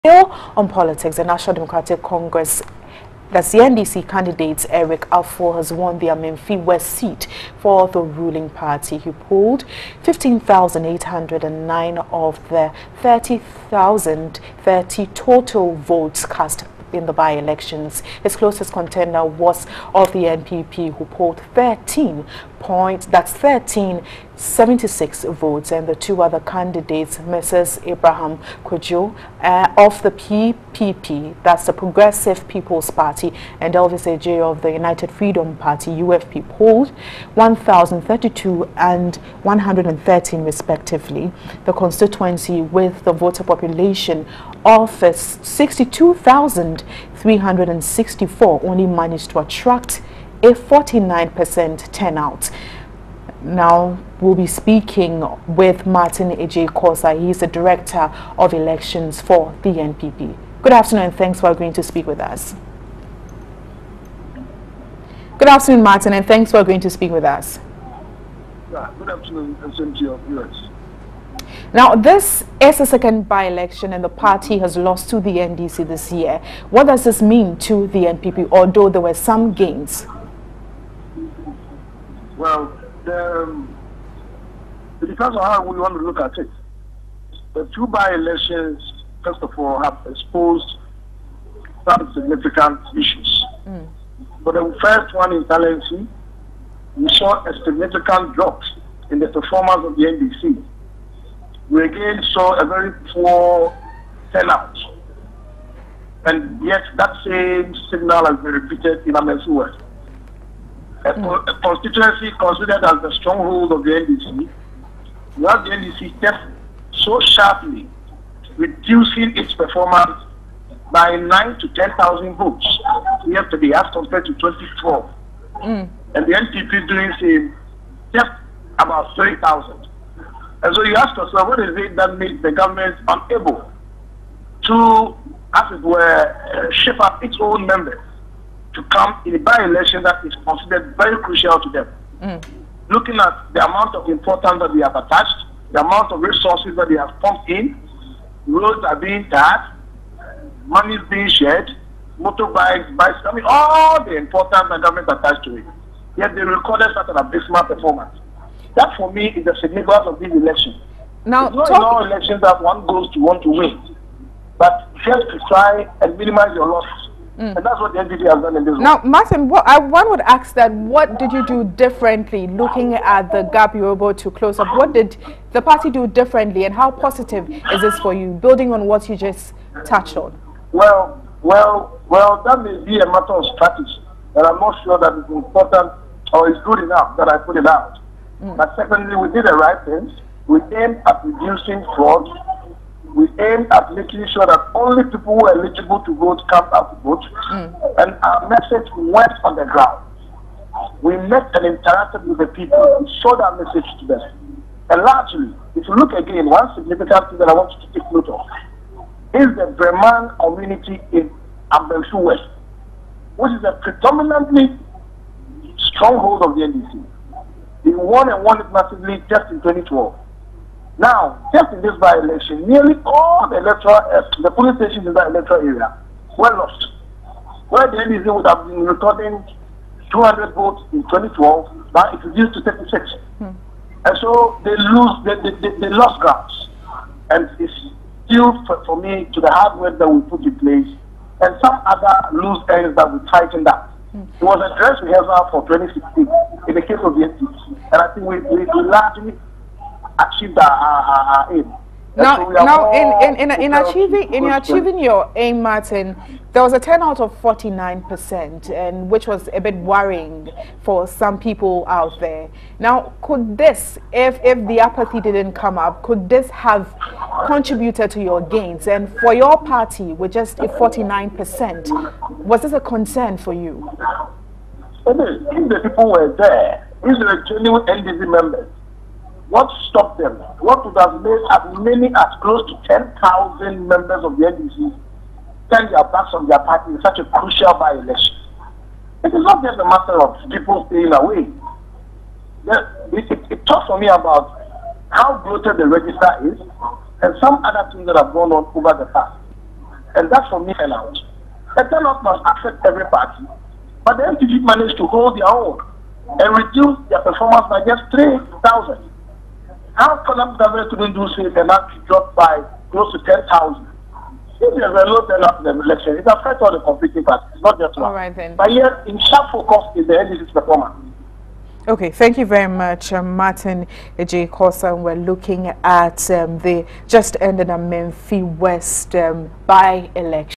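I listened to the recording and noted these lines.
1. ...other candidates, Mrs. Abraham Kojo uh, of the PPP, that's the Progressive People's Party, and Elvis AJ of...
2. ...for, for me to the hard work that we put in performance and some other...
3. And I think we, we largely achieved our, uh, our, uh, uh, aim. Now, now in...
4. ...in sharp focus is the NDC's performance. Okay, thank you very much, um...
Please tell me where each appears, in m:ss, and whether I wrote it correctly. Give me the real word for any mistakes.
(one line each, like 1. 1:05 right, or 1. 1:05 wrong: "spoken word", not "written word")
1. 0:26 right
2. 3:58 wrong: "place", not "performance"
3. 4:07 right
4. 5:19 right.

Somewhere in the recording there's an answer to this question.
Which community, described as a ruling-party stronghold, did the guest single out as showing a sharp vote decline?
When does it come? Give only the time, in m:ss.
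3:29.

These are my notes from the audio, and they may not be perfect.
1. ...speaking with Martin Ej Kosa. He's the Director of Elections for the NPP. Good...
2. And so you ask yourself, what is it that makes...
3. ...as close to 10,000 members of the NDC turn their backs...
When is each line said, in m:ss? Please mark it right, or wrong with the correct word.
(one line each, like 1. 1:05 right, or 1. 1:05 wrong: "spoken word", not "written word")
1. 0:54 right
2. 2:10 right
3. 4:42 right.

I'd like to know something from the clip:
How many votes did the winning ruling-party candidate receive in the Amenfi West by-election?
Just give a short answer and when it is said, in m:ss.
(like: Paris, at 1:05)
15,809, at 0:10.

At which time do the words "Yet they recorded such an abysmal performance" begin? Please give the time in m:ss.
2:36.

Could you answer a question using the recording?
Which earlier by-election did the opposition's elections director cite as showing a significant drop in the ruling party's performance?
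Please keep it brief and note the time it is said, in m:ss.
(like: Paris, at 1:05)
Talensi, at 1:35.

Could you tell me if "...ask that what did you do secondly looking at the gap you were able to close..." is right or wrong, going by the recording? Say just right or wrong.
wrong.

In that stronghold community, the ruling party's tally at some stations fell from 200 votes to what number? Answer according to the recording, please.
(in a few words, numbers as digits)
36.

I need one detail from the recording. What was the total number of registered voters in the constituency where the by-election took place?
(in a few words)
62,364.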